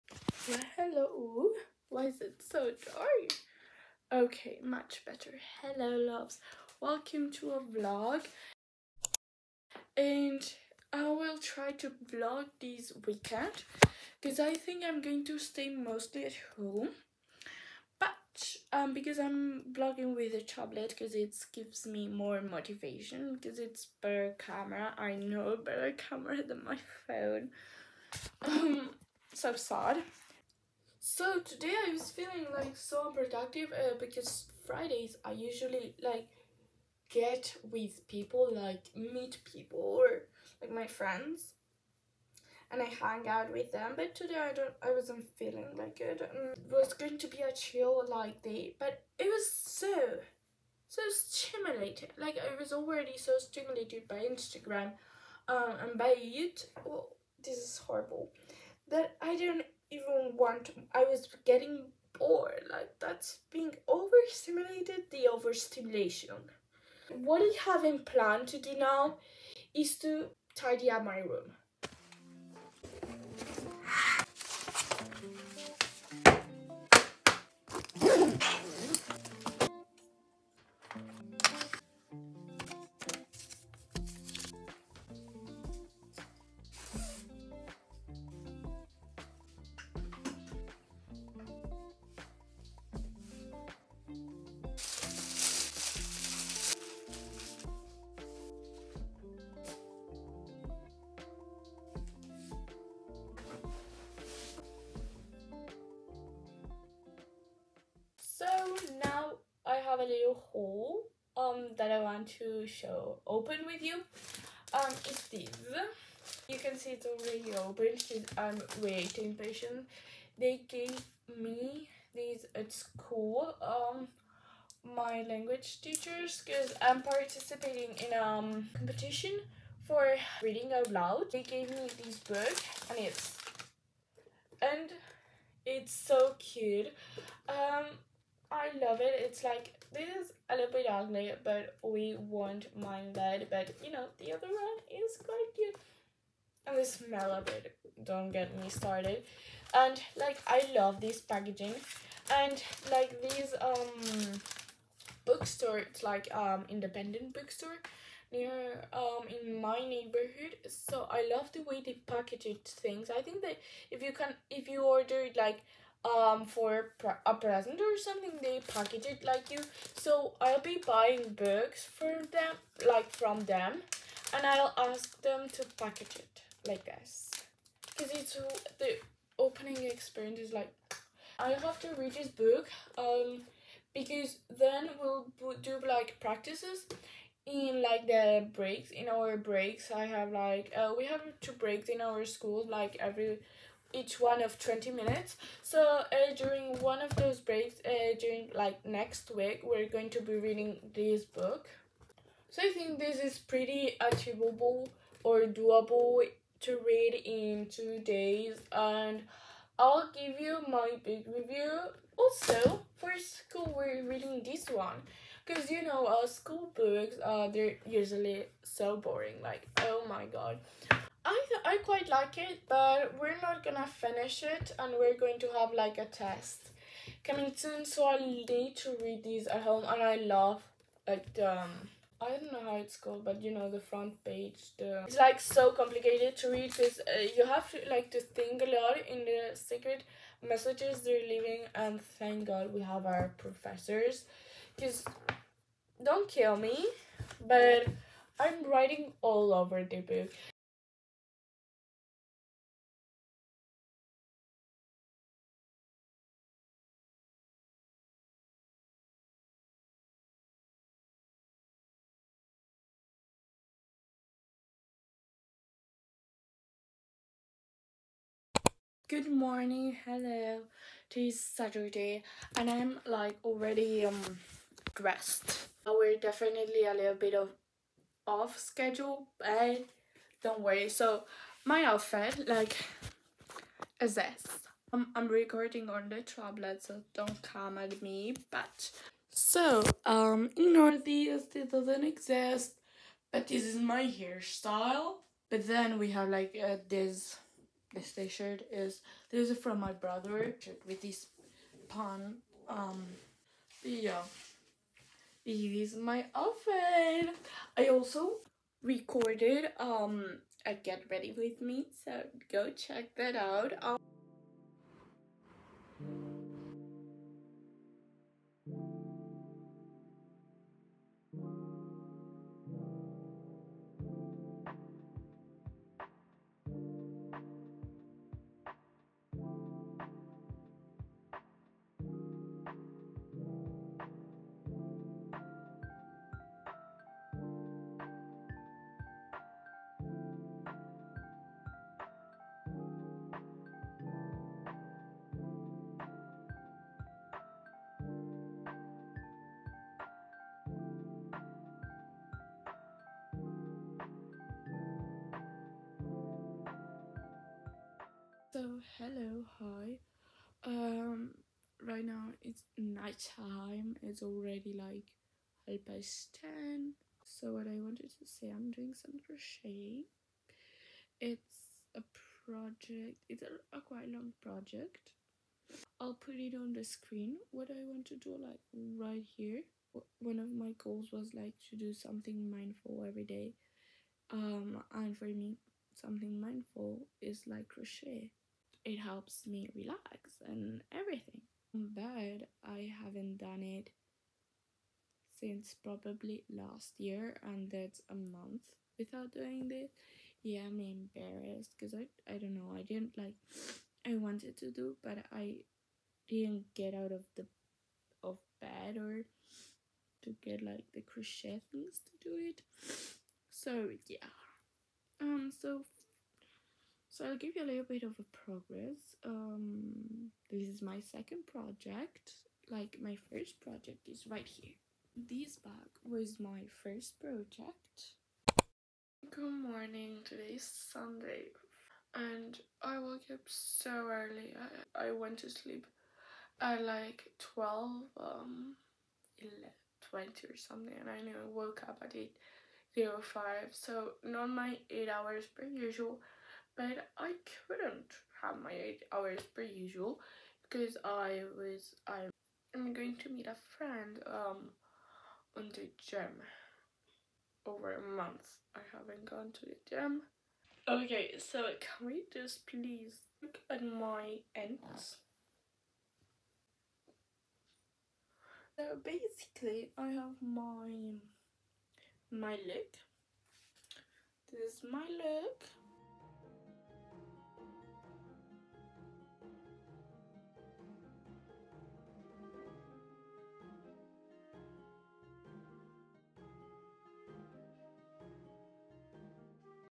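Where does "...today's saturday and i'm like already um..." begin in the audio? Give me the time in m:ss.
4:31.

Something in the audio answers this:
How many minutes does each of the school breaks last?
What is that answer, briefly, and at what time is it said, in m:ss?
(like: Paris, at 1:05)
20, at 3:14.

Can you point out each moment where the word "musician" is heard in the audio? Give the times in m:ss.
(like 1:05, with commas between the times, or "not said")
not said.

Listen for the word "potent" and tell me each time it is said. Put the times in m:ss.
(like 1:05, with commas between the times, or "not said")
not said.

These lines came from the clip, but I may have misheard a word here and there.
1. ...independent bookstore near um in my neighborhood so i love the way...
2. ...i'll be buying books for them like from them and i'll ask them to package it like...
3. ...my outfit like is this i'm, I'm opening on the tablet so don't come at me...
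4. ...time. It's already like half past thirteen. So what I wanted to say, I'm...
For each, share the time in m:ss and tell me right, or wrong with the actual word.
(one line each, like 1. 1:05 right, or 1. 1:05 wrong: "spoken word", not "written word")
1. 2:36 right
2. 2:50 right
3. 4:41 wrong: "recording", not "opening"
4. 6:03 wrong: "ten", not "thirteen".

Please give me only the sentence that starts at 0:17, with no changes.
But um, because I'm vlogging with a tablet because it gives me more motivation because it's better camera.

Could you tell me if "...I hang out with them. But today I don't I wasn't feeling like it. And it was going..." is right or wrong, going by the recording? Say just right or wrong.
right.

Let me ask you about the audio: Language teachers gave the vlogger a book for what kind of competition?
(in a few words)
Reading out loud.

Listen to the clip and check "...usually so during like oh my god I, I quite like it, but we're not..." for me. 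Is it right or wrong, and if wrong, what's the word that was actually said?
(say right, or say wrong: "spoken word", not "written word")
wrong: "boring", not "during".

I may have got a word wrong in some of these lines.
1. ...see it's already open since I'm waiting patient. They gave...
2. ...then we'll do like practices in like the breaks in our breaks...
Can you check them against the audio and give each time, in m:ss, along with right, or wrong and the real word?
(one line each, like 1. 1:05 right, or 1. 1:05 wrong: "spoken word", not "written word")
1. 1:56 right
2. 3:04 right.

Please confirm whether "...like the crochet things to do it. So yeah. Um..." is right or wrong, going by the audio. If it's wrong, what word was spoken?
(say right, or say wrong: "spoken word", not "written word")
right.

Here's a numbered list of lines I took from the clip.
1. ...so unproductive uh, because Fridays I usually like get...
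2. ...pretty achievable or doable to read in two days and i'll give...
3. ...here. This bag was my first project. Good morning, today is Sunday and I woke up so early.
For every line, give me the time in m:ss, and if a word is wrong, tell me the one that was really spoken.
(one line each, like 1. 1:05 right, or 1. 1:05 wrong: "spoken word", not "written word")
1. 0:32 right
2. 3:23 right
3. 7:04 right.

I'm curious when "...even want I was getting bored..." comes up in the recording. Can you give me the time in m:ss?
0:59.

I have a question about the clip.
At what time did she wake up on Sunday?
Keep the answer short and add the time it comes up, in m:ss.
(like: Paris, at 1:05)
8:05, at 7:22.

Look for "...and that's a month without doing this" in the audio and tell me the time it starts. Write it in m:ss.
6:37.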